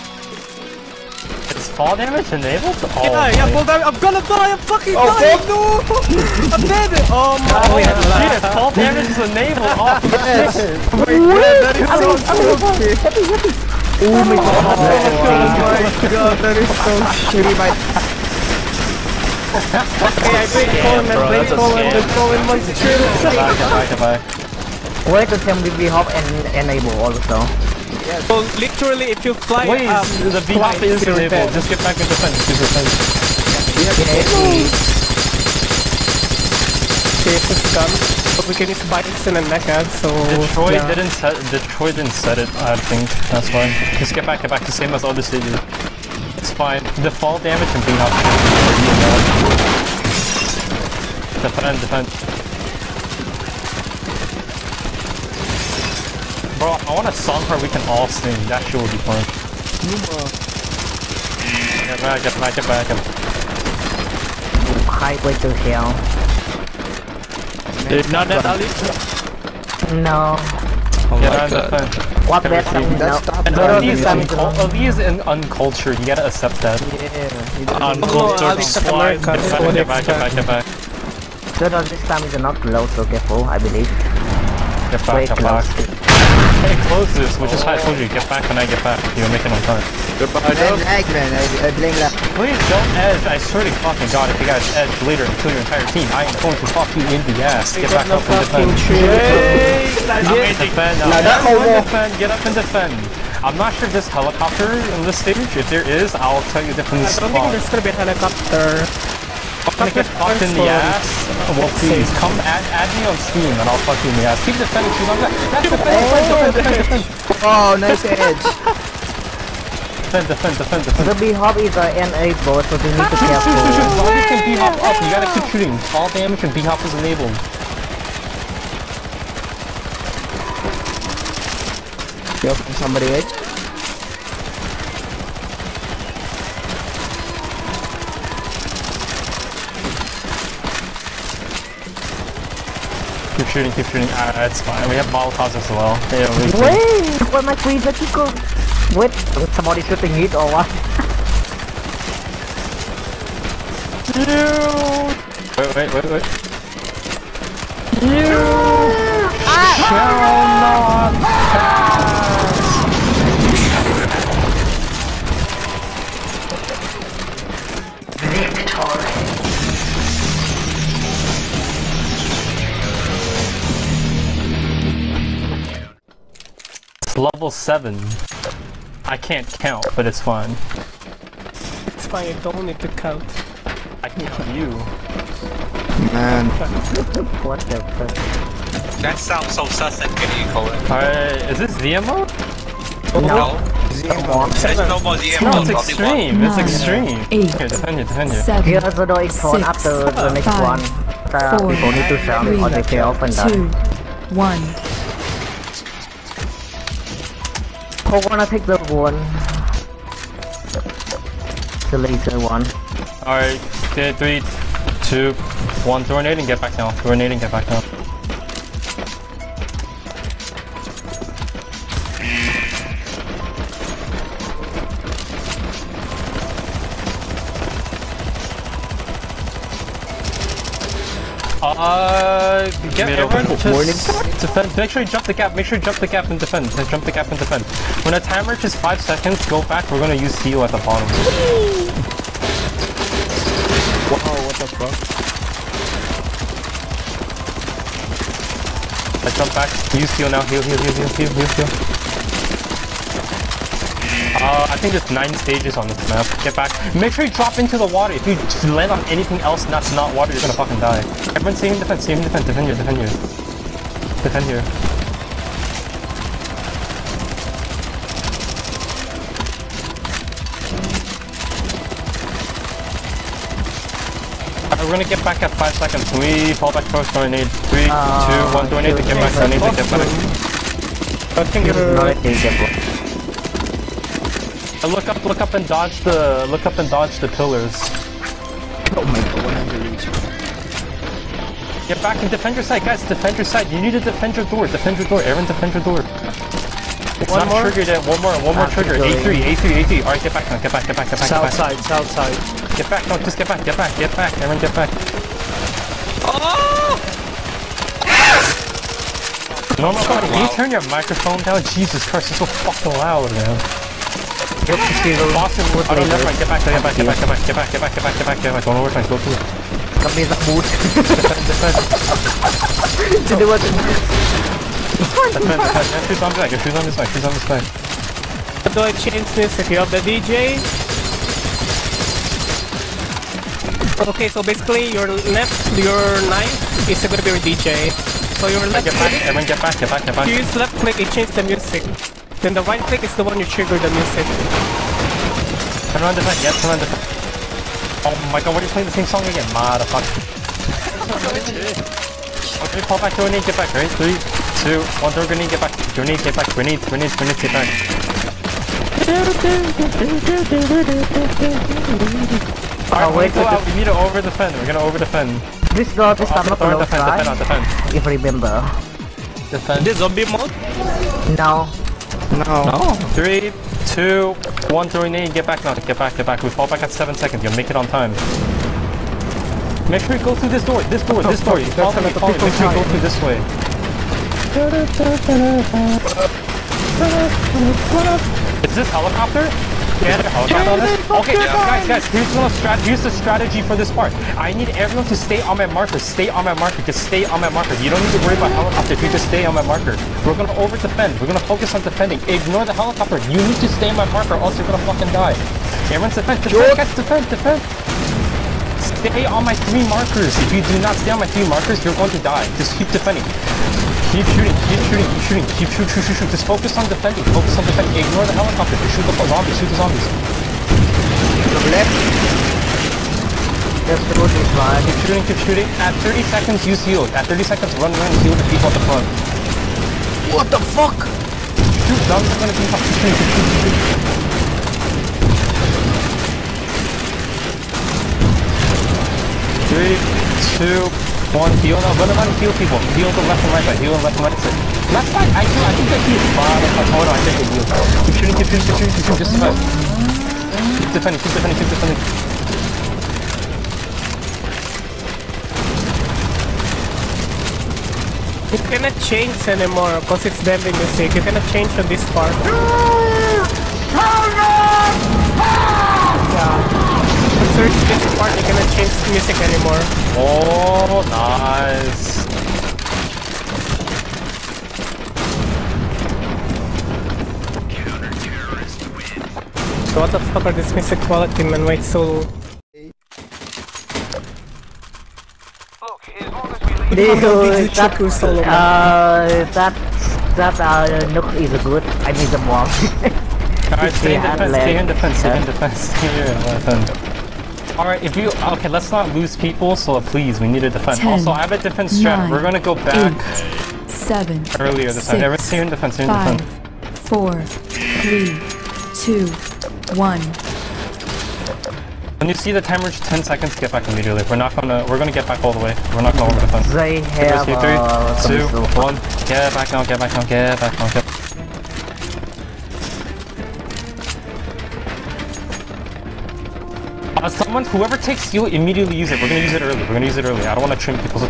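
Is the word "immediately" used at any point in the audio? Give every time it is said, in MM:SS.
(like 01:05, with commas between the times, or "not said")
08:33, 08:48.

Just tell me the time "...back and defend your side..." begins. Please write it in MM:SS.
04:52.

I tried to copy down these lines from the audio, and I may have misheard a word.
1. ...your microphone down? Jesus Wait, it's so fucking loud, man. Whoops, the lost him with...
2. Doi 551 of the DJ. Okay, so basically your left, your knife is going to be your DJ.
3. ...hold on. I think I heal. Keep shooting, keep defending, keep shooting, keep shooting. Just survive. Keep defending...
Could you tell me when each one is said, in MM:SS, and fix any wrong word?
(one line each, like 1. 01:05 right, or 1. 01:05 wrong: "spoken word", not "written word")
1. 05:10 wrong: "Christ", not "Wait"
2. 05:28 wrong: "550", not "551"
3. 07:26 wrong: "shooting", not "defending".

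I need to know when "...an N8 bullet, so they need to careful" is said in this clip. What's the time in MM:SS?
02:01.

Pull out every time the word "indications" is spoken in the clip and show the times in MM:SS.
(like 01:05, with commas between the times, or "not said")
not said.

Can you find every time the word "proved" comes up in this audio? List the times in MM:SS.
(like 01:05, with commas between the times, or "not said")
not said.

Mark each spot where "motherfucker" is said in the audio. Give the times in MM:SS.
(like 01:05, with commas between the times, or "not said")
05:49, 07:26.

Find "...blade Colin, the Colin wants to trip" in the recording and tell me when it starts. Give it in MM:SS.
00:21.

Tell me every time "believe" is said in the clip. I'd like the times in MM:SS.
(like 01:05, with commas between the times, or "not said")
01:23.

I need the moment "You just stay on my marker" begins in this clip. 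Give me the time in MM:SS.
06:39.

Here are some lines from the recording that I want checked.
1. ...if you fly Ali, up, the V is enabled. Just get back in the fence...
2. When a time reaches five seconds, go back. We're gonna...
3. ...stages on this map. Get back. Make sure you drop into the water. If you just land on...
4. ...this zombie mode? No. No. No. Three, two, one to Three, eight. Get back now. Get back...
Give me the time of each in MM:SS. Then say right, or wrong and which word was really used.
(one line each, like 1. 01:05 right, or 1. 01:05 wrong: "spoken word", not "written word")
1. 00:29 wrong: "Wait", not "Ali"
2. 03:58 right
3. 04:15 right
4. 06:09 right.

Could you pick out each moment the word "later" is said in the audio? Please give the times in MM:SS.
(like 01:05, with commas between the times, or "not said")
01:35.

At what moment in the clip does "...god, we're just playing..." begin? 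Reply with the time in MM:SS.
05:48.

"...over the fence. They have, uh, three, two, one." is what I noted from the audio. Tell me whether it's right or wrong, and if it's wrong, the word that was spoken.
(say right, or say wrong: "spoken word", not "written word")
right.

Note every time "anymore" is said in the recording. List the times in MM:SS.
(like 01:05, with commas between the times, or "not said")
07:39, 07:49.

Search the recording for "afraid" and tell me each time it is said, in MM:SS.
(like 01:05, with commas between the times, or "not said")
not said.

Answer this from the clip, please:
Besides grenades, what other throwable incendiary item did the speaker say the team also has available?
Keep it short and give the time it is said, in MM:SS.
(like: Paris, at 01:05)
Molotovs, at 02:25.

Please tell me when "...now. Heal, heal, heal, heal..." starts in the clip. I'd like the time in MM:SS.
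04:10.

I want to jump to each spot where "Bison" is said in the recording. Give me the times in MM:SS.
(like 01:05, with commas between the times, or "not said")
00:38.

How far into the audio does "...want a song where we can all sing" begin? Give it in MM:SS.
00:56.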